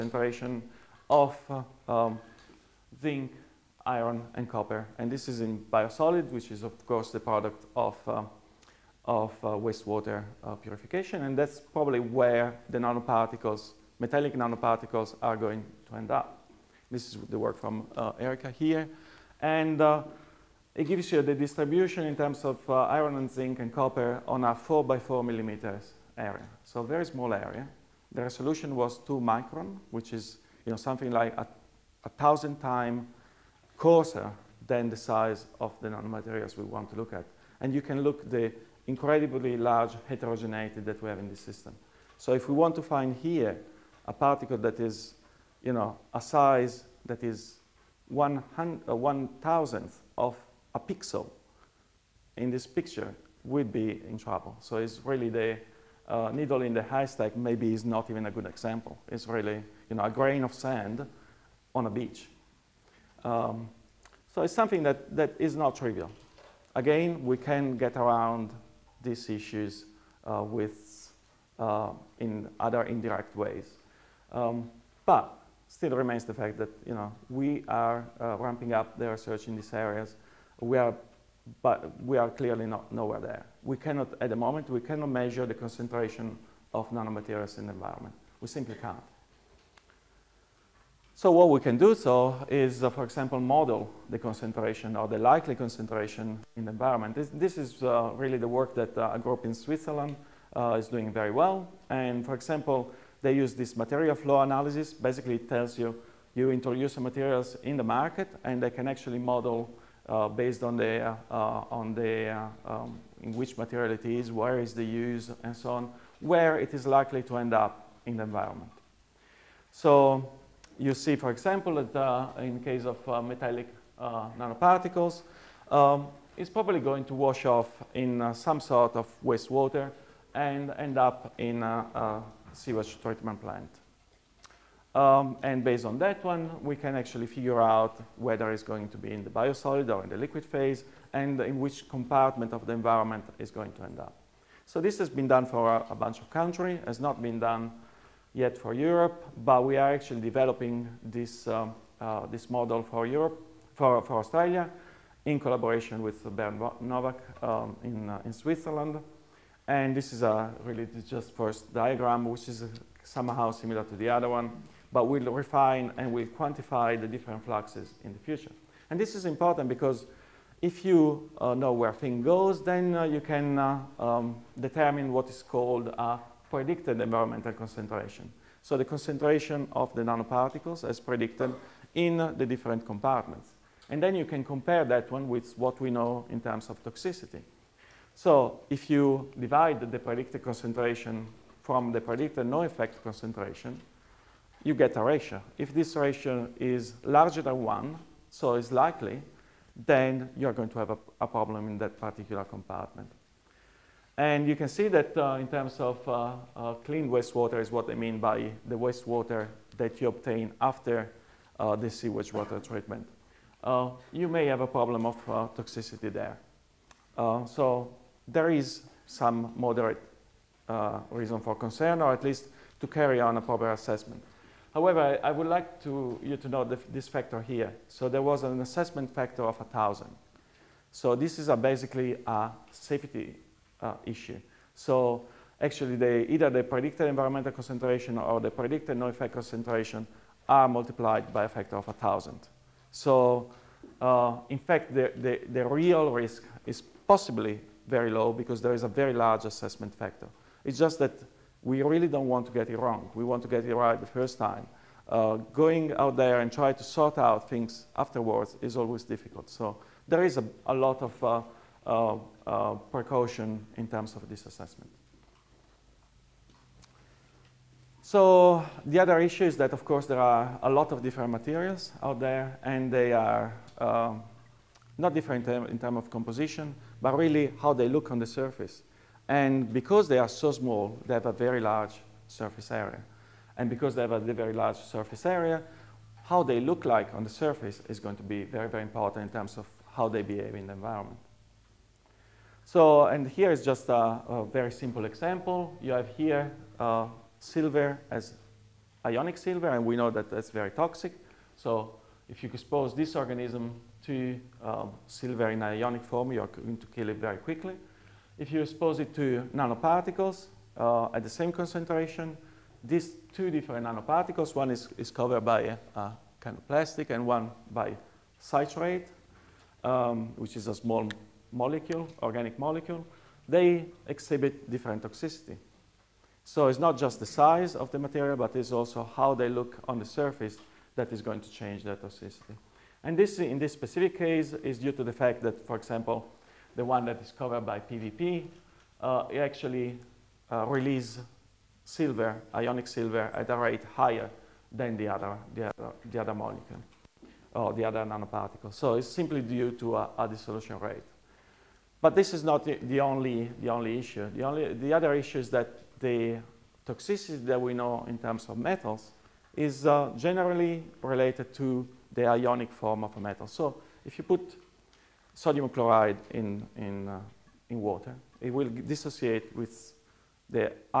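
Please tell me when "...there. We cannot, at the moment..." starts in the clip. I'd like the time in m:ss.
1:23.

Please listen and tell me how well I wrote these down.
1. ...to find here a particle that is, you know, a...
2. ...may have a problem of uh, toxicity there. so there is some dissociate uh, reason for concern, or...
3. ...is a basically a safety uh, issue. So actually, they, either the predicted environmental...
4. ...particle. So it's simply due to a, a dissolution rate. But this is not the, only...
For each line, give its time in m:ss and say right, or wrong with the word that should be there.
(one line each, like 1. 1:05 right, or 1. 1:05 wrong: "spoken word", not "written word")
1. 0:42 right
2. 3:34 wrong: "moderate", not "dissociate"
3. 3:51 right
4. 5:48 wrong: "nanoparticle", not "particle".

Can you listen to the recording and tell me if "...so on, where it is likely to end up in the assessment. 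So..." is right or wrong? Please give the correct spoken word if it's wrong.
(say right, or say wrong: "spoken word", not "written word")
wrong: "environment", not "assessment".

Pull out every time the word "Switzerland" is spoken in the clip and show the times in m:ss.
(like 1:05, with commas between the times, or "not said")
1:39, 2:38.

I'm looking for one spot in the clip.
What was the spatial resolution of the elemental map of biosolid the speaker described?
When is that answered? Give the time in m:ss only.
0:28.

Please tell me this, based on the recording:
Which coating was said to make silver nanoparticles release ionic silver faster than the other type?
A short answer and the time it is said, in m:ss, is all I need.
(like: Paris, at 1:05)
PVP, at 5:37.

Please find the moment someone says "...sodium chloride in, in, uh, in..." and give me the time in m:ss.
6:05.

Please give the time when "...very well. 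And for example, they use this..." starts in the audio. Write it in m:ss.
1:41.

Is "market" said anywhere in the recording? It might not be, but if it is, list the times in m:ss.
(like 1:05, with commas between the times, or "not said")
1:47.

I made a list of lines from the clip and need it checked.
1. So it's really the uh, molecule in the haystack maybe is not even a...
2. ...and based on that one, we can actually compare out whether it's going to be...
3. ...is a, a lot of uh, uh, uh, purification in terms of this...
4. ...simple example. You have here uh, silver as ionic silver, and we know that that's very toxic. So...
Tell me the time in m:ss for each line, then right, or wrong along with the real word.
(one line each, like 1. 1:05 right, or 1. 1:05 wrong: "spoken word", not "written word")
1. 0:54 wrong: "needle", not "molecule"
2. 2:15 wrong: "figure", not "compare"
3. 4:20 wrong: "precaution", not "purification"
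4. 4:54 right.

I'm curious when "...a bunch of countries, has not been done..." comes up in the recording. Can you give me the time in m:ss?
2:25.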